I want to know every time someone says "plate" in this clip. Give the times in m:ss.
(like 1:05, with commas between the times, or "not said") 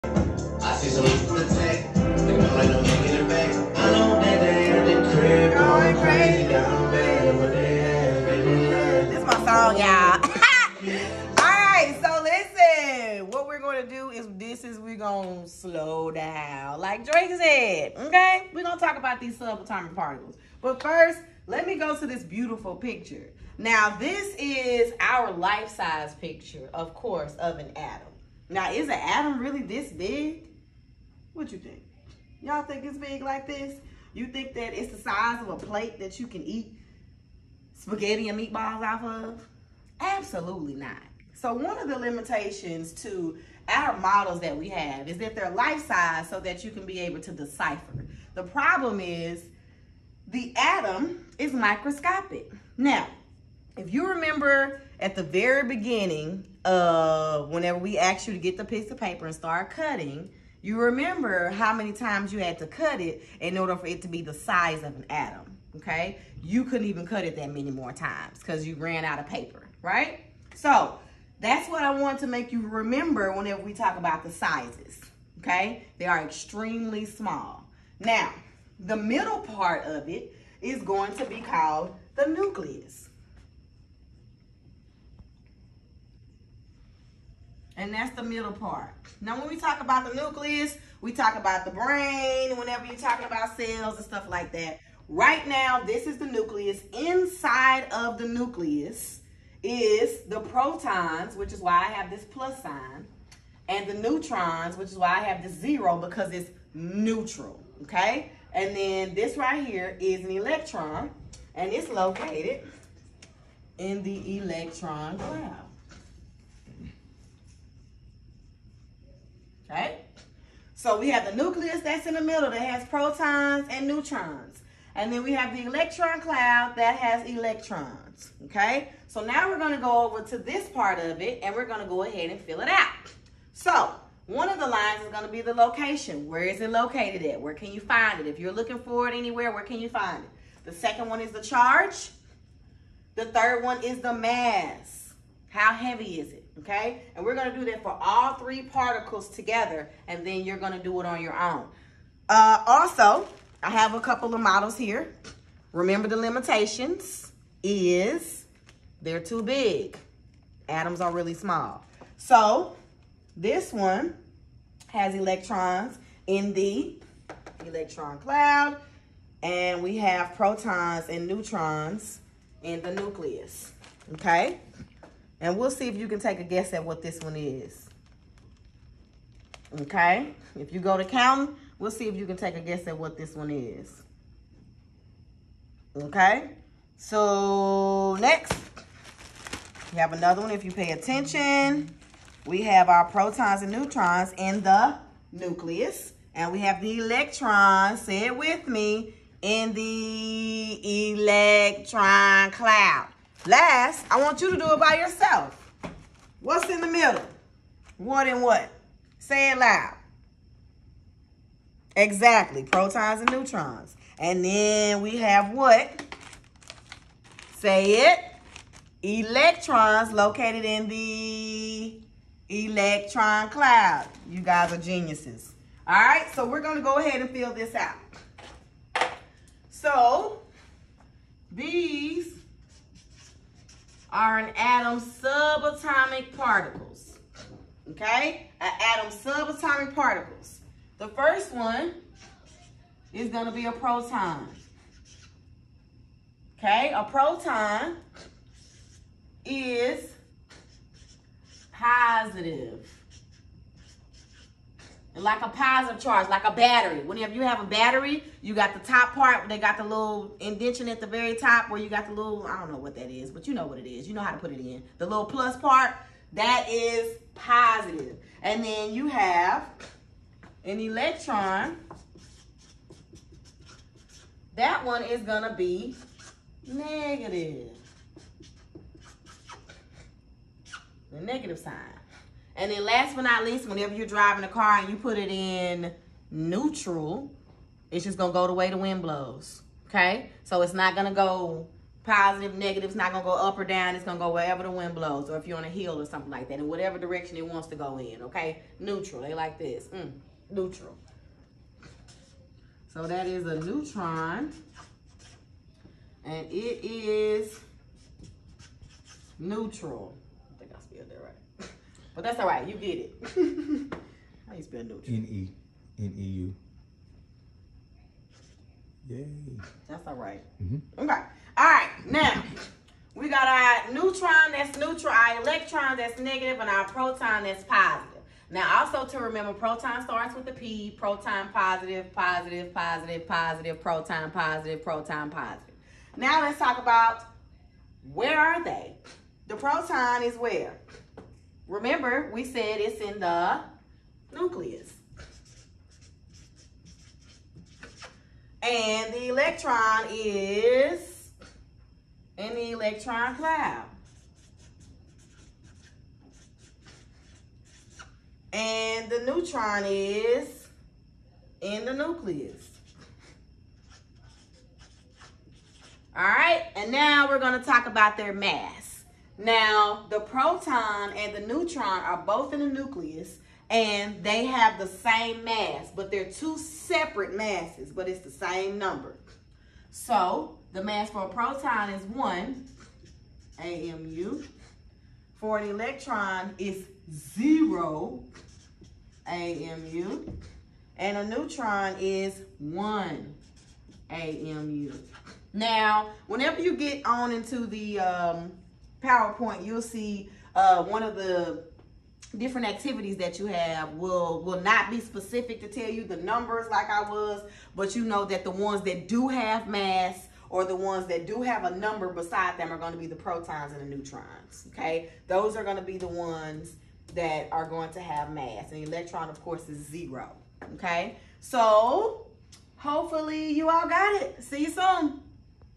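0:35.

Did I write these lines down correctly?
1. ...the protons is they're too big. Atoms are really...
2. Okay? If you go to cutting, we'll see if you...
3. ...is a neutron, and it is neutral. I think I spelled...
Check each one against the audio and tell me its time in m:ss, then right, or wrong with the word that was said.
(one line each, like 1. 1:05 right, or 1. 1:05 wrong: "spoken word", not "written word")
1. 2:36 wrong: "limitations", not "protons"
2. 2:59 wrong: "counting", not "cutting"
3. 5:03 right.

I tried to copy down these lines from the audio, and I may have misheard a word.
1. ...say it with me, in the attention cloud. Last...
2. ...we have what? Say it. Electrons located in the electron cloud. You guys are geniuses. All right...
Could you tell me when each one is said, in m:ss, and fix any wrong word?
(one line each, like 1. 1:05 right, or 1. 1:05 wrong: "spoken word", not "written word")
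1. 3:18 wrong: "electron", not "attention"
2. 3:35 right.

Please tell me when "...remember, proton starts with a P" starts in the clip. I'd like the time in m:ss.
5:29.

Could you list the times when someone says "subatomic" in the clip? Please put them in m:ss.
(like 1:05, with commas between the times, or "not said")
0:19, 3:55, 3:59.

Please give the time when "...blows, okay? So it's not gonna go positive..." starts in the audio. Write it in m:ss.
4:49.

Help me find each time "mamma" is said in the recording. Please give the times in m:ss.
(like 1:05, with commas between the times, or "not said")
not said.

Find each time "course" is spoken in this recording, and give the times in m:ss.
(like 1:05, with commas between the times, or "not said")
0:26, 6:59.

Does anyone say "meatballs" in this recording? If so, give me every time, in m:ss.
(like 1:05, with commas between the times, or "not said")
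0:38.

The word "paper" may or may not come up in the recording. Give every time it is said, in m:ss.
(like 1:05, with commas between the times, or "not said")
0:58, 1:09.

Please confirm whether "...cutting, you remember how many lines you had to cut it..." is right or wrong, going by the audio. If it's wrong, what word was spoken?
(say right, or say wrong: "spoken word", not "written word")
wrong: "times", not "lines".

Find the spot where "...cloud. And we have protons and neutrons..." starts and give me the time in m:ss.
2:48.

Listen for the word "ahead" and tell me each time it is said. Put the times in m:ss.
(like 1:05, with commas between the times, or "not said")
2:12, 3:46.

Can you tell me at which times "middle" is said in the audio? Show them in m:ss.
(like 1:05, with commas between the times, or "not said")
1:18, 1:28, 2:02, 3:26.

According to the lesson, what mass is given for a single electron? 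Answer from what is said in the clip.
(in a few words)
0 AMU.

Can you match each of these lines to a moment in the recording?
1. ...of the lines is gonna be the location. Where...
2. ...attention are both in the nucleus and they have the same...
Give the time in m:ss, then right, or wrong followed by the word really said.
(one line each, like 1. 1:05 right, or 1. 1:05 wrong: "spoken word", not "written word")
1. 2:14 right
2. 6:11 wrong: "neutron", not "attention".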